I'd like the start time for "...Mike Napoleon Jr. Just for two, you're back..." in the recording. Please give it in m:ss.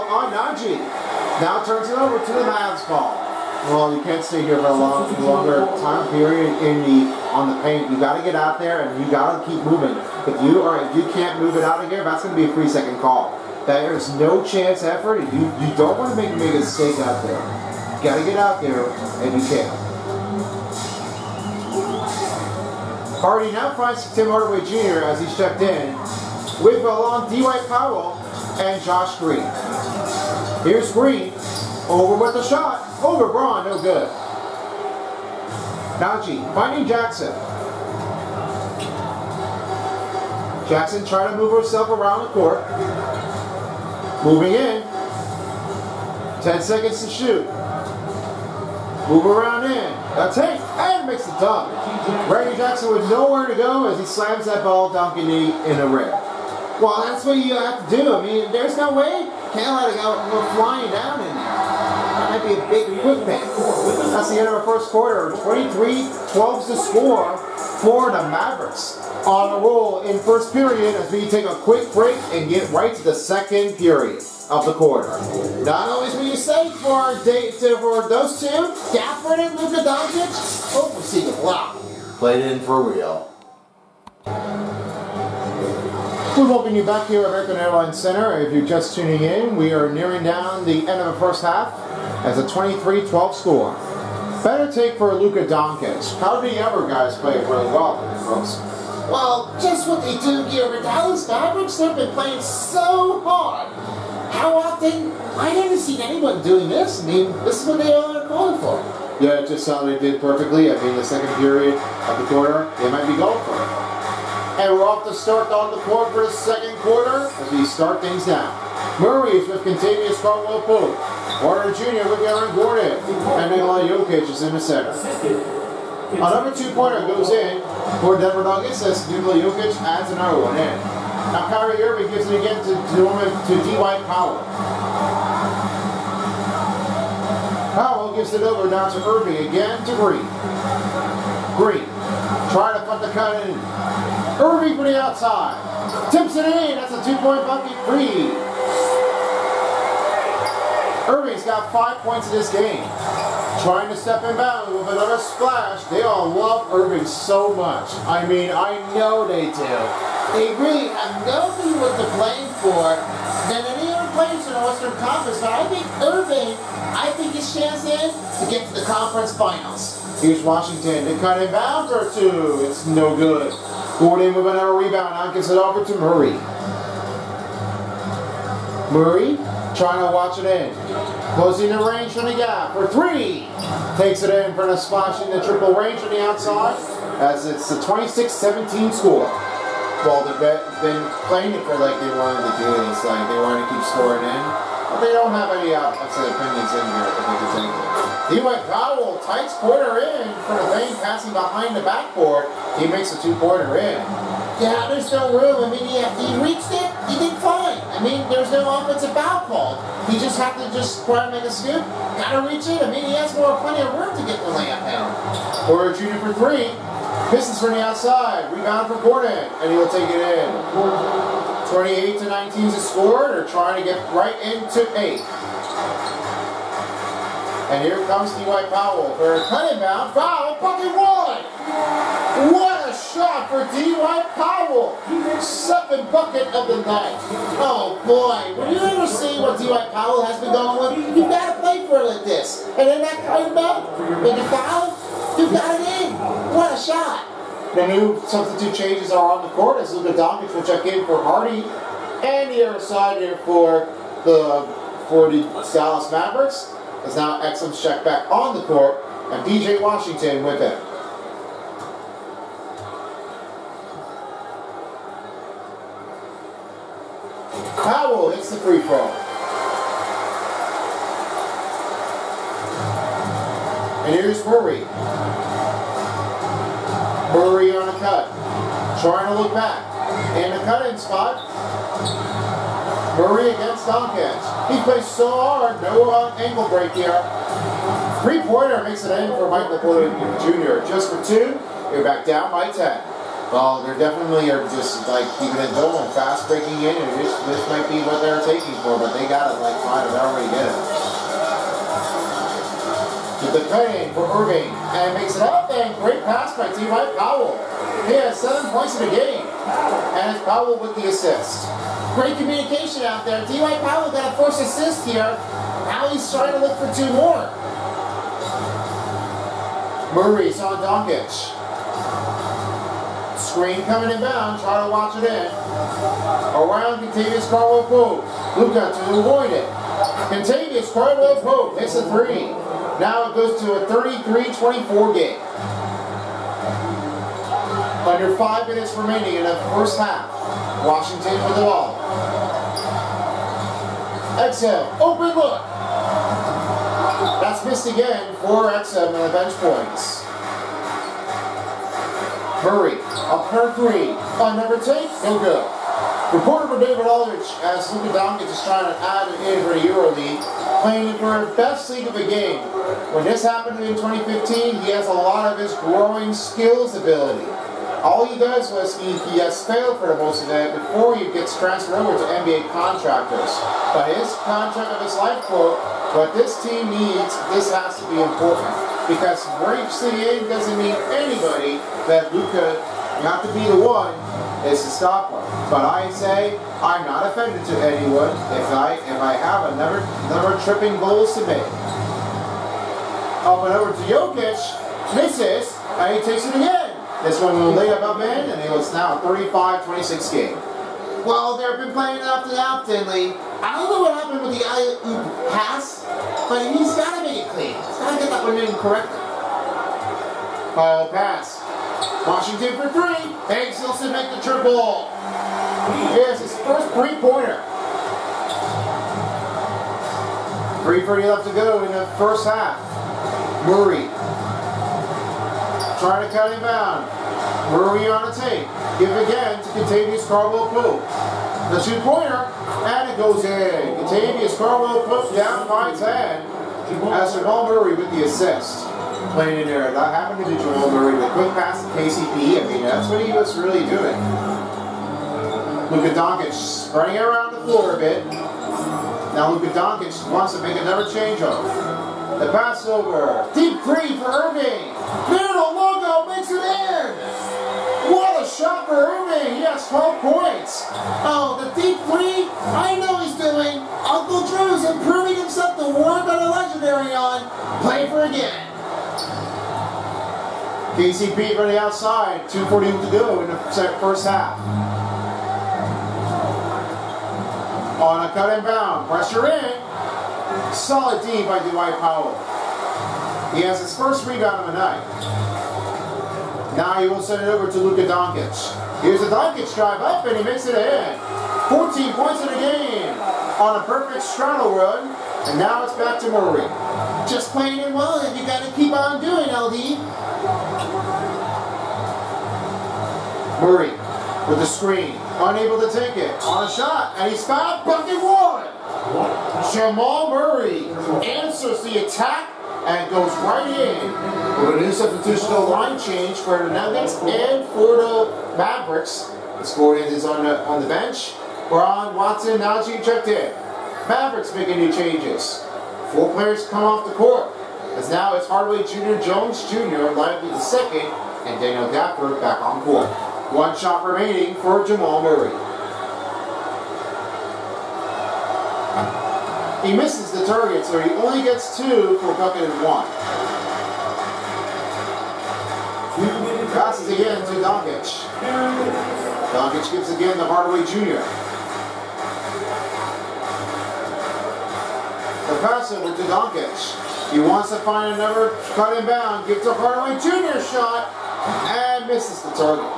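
4:49.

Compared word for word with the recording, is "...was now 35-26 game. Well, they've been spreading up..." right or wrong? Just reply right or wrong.
wrong.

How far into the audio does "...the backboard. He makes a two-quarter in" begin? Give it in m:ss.
3:21.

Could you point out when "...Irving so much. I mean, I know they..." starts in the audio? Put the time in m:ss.
2:36.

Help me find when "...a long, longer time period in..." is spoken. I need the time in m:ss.
0:04.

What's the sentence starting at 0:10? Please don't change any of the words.
If you are, if you can't move it out of here, that's going to be a three second call.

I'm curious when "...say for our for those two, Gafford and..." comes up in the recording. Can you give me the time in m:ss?
1:16.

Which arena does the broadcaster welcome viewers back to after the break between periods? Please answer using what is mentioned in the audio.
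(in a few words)
American Airlines Center.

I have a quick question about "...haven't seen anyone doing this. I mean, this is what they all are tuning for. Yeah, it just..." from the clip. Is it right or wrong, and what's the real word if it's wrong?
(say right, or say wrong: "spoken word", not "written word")
wrong: "calling", not "tuning".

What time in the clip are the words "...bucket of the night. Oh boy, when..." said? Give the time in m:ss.
3:56.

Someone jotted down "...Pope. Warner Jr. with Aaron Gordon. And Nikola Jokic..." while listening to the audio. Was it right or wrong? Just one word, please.
right.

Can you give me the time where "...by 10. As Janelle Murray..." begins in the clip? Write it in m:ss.
7:15.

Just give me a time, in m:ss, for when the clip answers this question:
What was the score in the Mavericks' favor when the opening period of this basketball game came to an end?
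1:05.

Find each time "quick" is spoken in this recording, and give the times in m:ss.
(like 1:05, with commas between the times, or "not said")
1:03, 1:11, 7:21.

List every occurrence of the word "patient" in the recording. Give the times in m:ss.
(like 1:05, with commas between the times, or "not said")
not said.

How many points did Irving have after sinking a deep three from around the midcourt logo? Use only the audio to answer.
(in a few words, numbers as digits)
12.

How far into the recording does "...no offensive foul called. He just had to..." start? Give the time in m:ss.
3:28.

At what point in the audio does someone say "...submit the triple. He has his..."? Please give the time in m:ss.
6:53.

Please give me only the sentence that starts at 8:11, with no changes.
14 points in a game on a perfect straddle run.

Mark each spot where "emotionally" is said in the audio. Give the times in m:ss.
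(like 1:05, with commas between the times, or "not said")
not said.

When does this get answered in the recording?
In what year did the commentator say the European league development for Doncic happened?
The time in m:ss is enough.
6:03.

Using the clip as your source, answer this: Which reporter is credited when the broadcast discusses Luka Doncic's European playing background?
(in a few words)
David Aldridge.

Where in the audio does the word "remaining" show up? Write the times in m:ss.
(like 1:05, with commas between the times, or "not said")
5:38, 8:54.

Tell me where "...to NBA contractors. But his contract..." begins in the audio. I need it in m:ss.
6:12.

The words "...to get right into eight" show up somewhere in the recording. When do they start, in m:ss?
3:43.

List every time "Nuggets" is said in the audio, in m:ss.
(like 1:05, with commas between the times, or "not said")
2:08, 8:36.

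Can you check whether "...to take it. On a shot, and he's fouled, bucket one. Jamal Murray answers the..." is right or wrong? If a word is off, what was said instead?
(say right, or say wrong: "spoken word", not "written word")
right.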